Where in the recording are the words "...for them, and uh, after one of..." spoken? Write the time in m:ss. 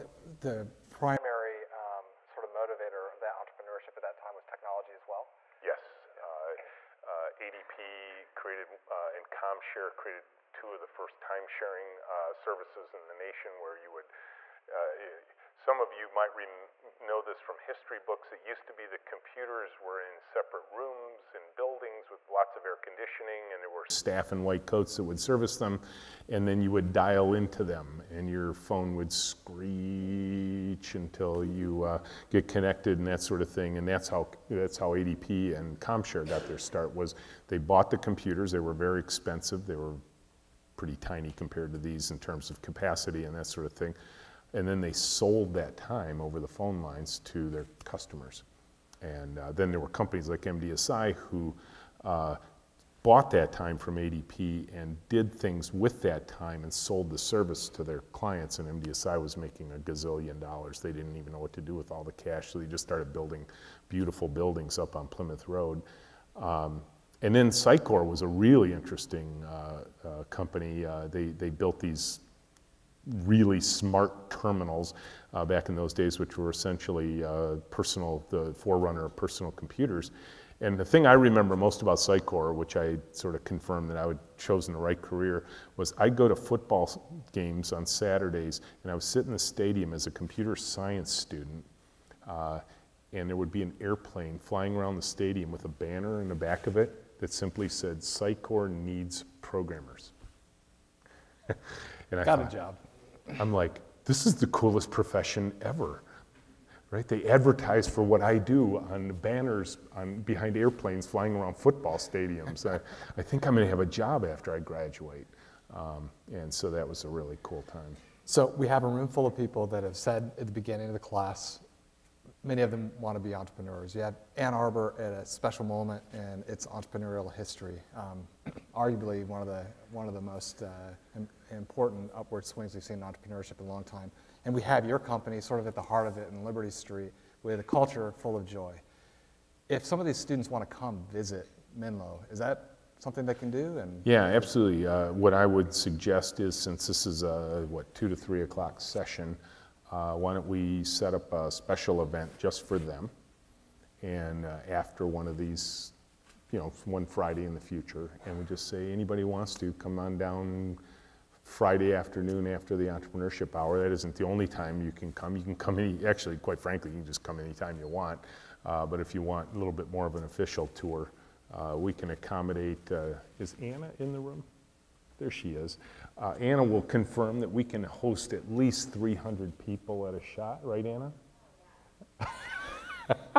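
2:32.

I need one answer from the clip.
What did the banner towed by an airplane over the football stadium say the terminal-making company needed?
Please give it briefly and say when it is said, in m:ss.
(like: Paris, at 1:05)
programmers, at 1:37.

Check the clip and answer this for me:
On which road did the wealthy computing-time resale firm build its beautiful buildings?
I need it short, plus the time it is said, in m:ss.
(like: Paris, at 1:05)
Plymouth Road, at 1:05.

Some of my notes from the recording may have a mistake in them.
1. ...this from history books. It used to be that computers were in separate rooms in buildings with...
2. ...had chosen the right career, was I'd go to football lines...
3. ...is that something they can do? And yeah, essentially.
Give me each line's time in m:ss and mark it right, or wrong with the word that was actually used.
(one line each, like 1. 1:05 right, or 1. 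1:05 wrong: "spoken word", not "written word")
1. 0:17 right
2. 1:24 wrong: "games", not "lines"
3. 2:22 wrong: "absolutely", not "essentially".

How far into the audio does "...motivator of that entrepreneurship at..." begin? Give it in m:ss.
0:02.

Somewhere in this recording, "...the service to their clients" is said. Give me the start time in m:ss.
0:57.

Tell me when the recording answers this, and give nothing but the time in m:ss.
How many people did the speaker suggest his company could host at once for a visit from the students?
2:58.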